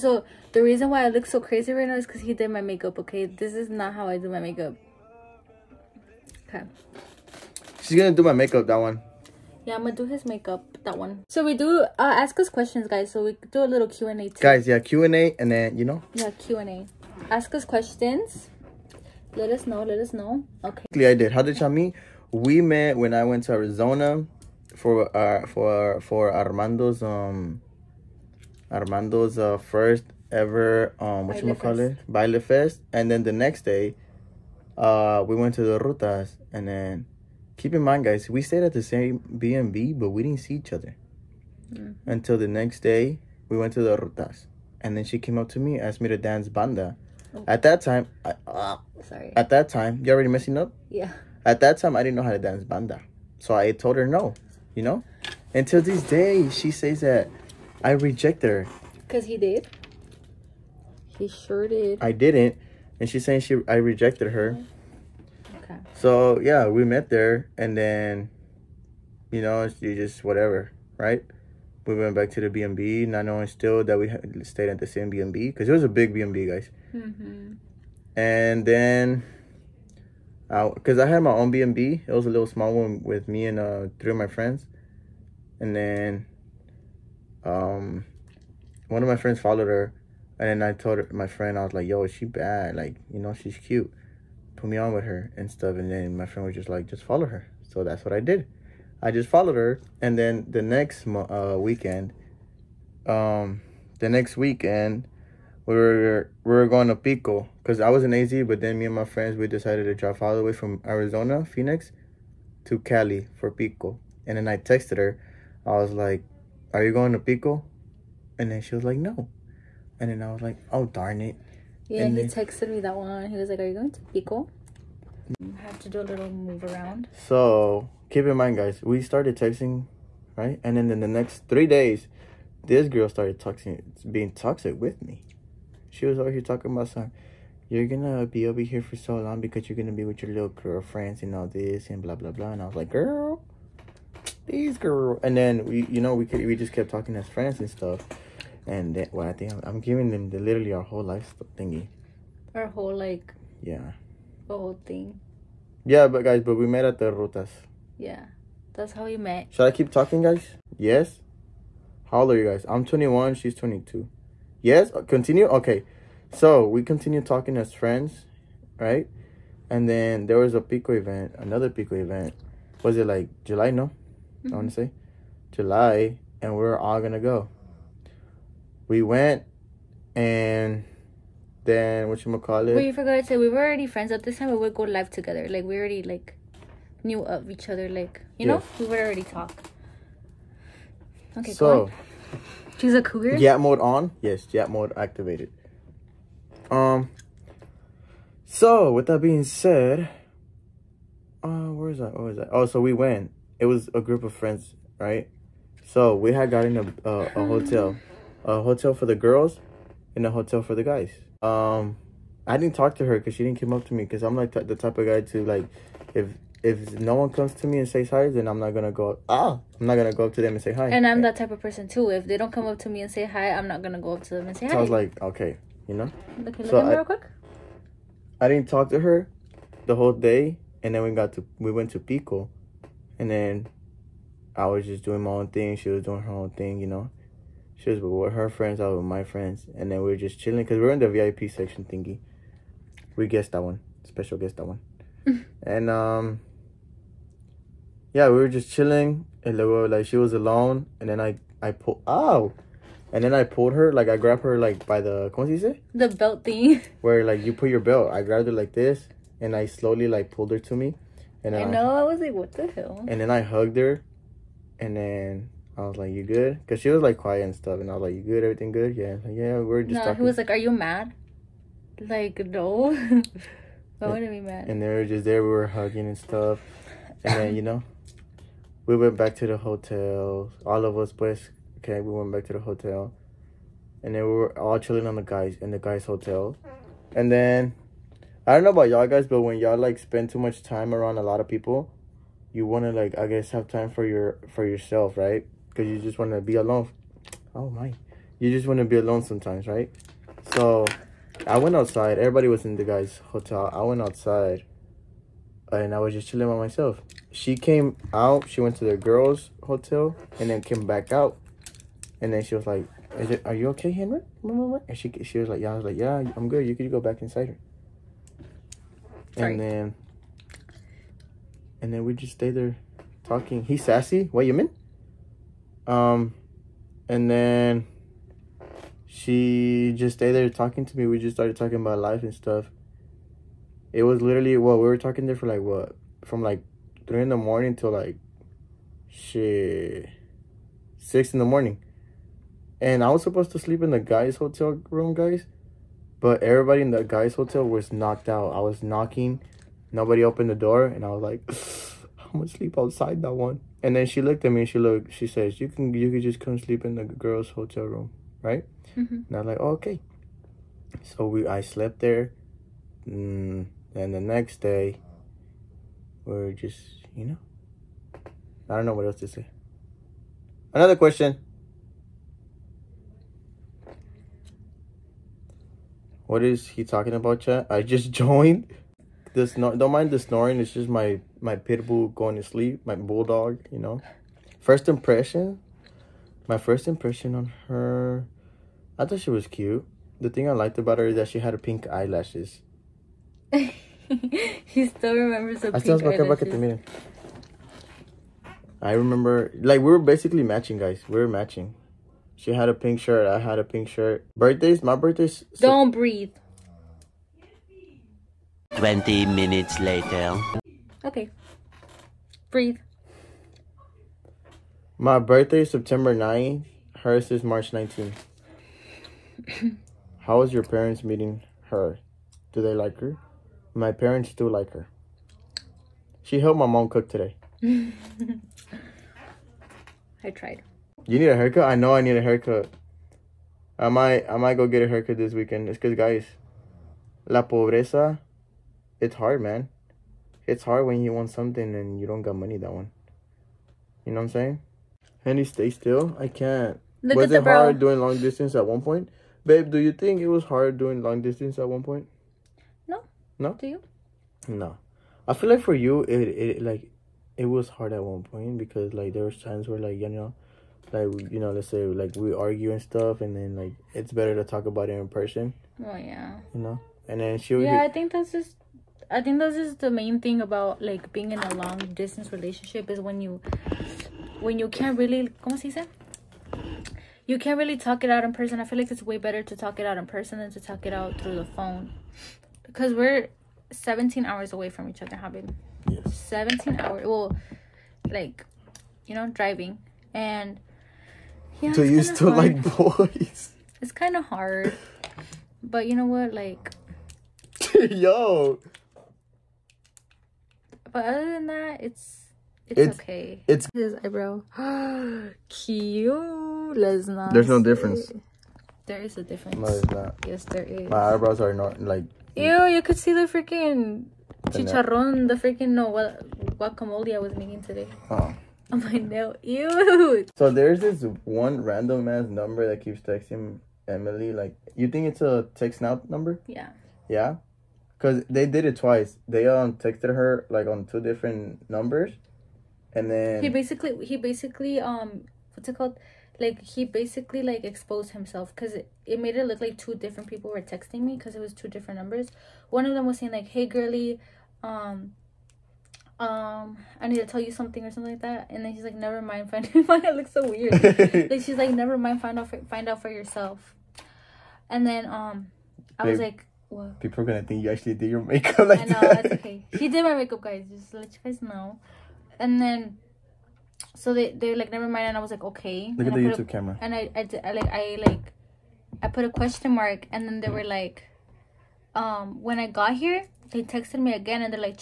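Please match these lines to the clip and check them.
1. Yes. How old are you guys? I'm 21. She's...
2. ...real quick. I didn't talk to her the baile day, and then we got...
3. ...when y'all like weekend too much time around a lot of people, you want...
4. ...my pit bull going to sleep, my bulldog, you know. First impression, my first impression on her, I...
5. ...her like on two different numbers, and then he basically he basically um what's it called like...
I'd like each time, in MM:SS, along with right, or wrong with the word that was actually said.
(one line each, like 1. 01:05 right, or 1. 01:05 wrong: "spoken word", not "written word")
1. 02:40 right
2. 03:46 wrong: "whole", not "baile"
3. 04:49 wrong: "spend", not "weekend"
4. 06:21 right
5. 08:50 right.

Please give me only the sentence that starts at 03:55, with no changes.
She was doing her own thing, you know.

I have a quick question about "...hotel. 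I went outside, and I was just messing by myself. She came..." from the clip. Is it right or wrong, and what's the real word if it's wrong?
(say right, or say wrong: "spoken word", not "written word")
wrong: "chilling", not "messing".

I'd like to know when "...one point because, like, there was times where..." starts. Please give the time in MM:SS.
07:38.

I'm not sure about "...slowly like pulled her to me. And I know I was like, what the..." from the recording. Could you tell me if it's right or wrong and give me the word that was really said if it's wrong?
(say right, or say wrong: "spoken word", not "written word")
right.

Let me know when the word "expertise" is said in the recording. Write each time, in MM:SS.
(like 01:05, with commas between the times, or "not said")
not said.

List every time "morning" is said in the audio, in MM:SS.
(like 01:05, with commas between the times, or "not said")
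05:37, 05:41.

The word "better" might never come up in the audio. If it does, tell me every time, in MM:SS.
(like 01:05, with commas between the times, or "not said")
07:44, 07:59.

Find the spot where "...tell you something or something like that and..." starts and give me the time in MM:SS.
09:07.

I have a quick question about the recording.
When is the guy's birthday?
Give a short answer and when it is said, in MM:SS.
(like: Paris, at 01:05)
September 9th, at 06:55.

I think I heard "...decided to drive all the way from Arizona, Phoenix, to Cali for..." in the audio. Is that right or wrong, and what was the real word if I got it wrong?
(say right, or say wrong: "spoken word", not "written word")
right.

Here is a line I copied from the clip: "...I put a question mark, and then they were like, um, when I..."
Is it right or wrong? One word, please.
right.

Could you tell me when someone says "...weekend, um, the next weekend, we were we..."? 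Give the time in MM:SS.
01:41.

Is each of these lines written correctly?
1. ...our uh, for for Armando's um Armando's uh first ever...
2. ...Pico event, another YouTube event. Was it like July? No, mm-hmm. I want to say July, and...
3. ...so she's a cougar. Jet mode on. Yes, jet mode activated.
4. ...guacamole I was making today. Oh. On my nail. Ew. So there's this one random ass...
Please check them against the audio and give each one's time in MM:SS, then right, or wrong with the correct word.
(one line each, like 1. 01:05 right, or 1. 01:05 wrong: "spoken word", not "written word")
1. 00:25 right
2. 02:50 wrong: "Pico", not "YouTube"
3. 03:11 right
4. 08:36 right.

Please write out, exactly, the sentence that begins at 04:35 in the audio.
We were hugging and stuff, and then you know, we went back to the hotel.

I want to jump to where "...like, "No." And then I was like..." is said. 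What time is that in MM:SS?
01:58.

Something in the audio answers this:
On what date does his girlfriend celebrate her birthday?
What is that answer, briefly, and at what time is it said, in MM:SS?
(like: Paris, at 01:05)
March 19th, at 06:57.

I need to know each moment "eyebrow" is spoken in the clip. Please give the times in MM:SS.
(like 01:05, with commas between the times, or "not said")
08:23, 08:31.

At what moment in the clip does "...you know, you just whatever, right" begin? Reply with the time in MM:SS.
01:09.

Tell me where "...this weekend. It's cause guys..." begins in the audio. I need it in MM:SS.
07:15.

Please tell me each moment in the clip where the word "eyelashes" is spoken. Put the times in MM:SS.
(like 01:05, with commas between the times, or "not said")
06:31, 06:36.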